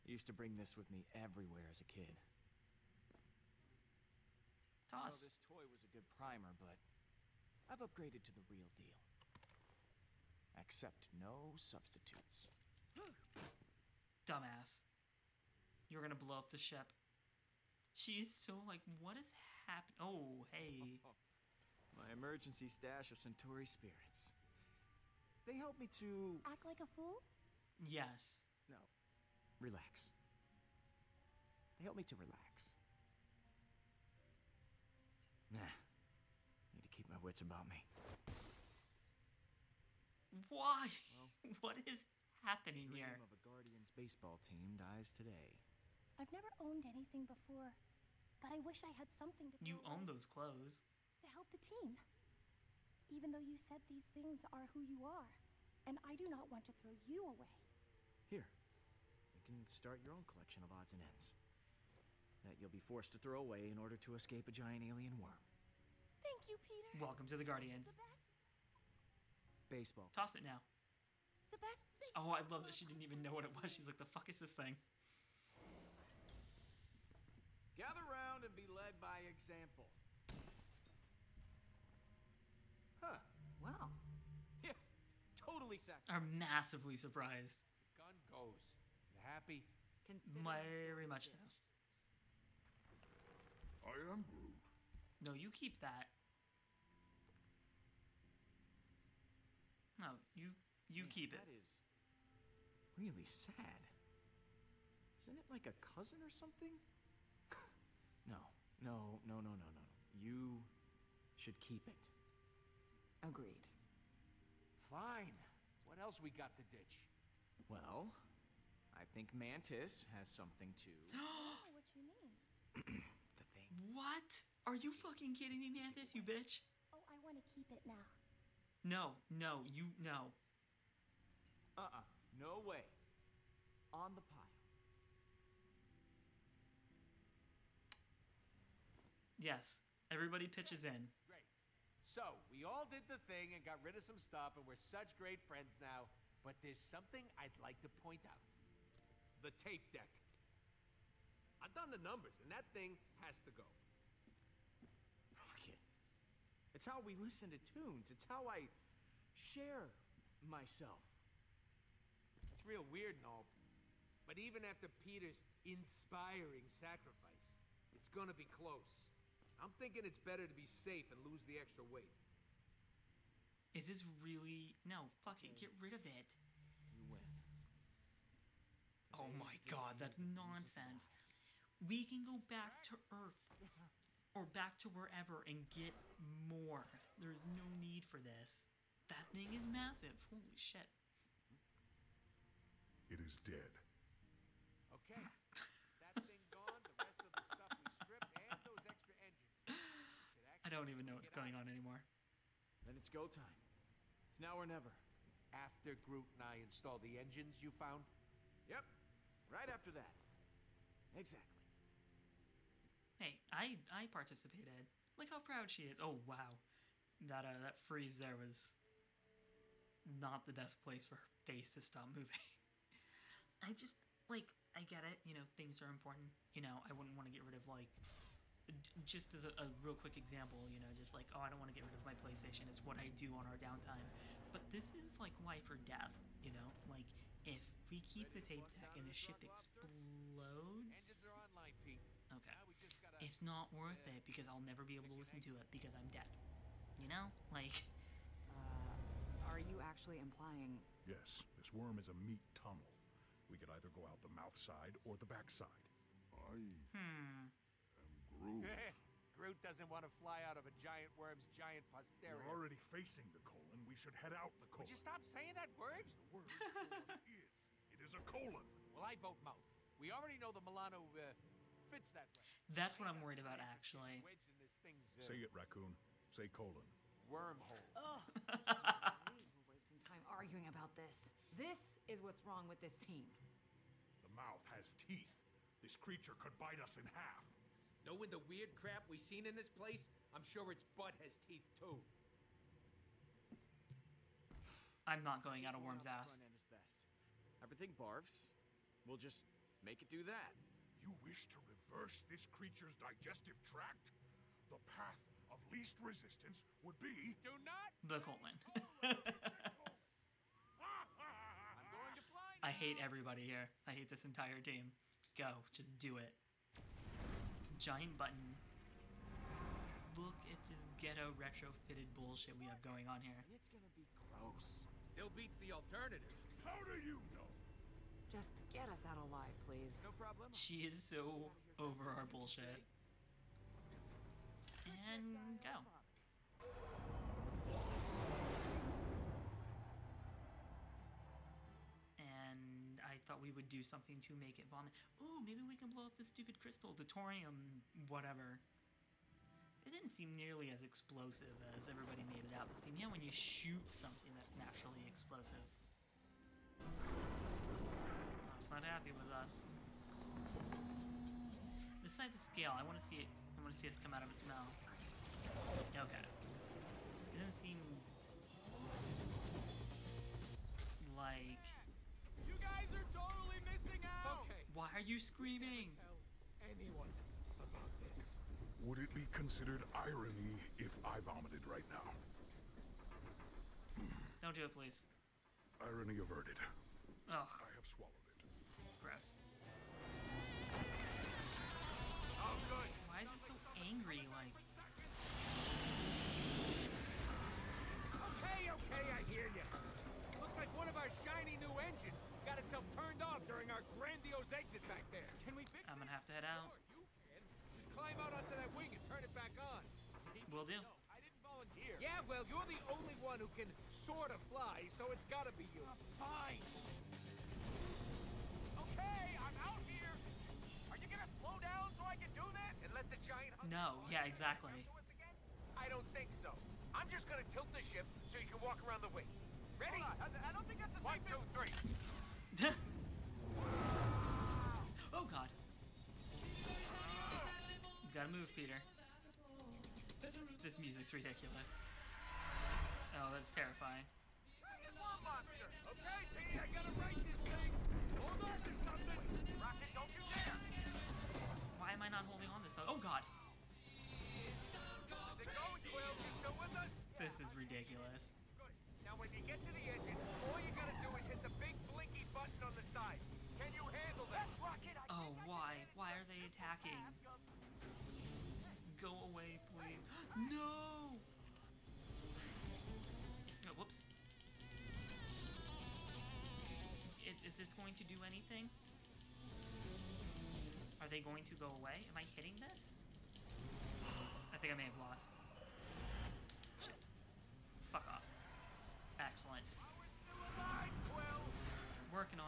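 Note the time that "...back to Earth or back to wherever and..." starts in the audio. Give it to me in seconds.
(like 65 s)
182 s.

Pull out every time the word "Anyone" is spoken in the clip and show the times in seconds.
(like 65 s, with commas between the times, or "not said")
376 s.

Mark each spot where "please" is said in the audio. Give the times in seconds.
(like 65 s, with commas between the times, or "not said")
329 s, 384 s, 469 s.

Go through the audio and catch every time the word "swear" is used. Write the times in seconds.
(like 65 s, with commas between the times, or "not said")
not said.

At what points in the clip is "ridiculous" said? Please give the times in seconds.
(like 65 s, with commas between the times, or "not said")
441 s, 457 s.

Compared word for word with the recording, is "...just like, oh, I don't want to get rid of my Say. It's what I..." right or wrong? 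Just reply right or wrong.
wrong.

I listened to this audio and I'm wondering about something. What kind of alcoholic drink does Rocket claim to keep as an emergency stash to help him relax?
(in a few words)
Centauri spirits.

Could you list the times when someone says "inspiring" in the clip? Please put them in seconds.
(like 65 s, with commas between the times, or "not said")
165 s.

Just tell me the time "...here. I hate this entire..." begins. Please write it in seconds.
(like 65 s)
313 s.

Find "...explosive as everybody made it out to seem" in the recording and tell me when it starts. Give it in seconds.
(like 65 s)
350 s.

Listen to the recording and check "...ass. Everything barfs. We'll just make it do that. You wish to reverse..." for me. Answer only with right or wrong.
right.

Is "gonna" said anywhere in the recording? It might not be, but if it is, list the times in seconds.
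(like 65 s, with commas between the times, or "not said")
16 s, 168 s, 323 s, 405 s, 421 s, 427 s.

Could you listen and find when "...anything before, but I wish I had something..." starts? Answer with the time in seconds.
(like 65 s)
46 s.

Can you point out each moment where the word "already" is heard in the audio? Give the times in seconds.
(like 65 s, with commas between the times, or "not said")
262 s, 270 s.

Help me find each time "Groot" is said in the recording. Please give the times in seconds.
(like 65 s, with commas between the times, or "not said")
94 s, 206 s, 259 s.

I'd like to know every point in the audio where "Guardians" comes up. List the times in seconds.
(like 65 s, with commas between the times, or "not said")
43 s, 67 s.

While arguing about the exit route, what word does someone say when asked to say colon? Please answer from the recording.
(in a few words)
Wormhole.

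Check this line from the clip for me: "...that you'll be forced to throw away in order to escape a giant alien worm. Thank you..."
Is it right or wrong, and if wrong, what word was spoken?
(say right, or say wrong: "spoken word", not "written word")
right.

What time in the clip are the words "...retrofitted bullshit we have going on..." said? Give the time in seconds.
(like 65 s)
321 s.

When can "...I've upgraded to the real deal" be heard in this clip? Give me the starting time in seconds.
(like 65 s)
7 s.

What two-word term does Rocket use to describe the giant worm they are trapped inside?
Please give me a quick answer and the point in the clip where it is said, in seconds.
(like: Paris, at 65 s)
Meat tunnel, at 252 s.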